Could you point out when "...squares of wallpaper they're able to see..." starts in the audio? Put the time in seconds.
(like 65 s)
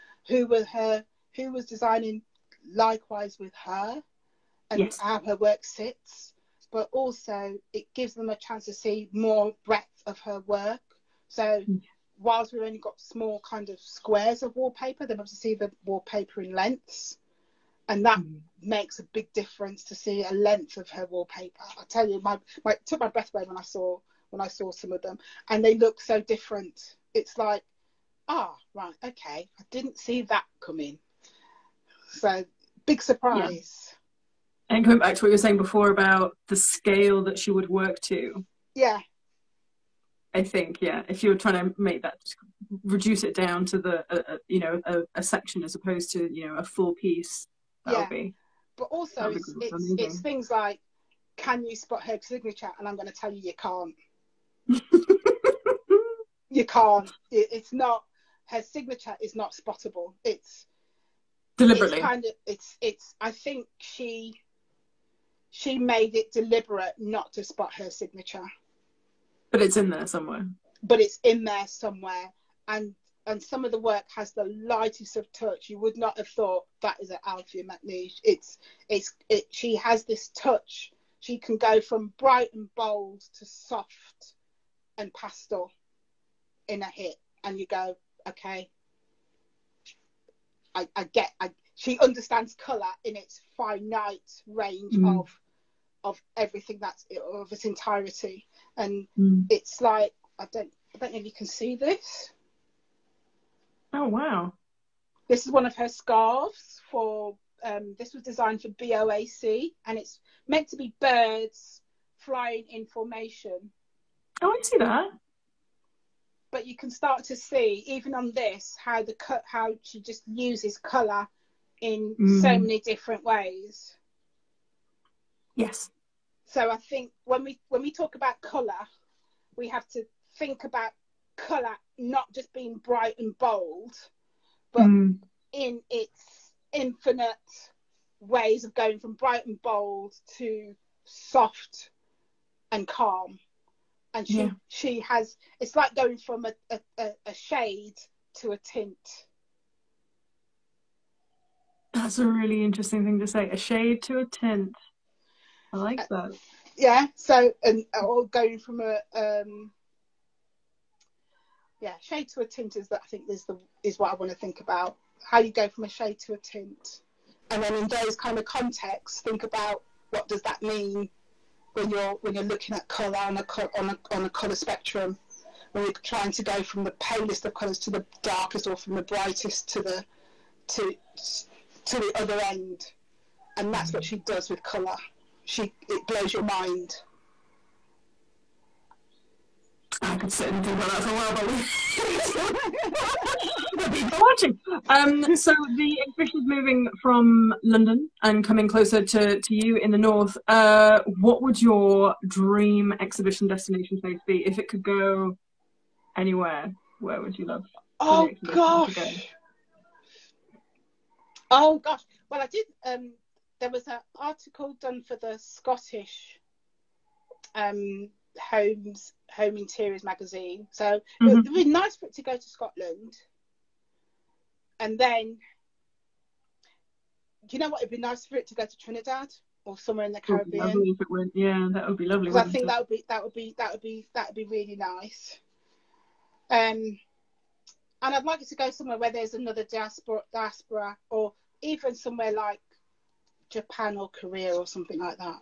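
13 s.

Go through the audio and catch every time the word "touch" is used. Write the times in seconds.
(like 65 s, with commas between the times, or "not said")
75 s, 80 s.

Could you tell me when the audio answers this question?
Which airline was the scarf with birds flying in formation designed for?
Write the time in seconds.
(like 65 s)
108 s.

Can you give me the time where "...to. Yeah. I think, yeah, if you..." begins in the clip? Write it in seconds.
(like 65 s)
38 s.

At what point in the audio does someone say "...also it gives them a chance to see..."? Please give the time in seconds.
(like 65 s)
6 s.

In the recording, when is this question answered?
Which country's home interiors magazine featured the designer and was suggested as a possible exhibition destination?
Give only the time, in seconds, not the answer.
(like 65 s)
215 s.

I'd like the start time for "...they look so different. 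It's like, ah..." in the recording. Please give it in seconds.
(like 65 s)
25 s.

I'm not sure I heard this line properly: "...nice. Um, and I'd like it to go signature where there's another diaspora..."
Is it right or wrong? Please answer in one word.
wrong.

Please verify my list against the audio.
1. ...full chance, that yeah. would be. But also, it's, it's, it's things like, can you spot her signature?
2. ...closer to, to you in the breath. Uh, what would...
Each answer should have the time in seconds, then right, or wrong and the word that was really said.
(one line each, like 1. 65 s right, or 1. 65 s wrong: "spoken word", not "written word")
1. 46 s wrong: "piece", not "chance"
2. 198 s wrong: "north", not "breath".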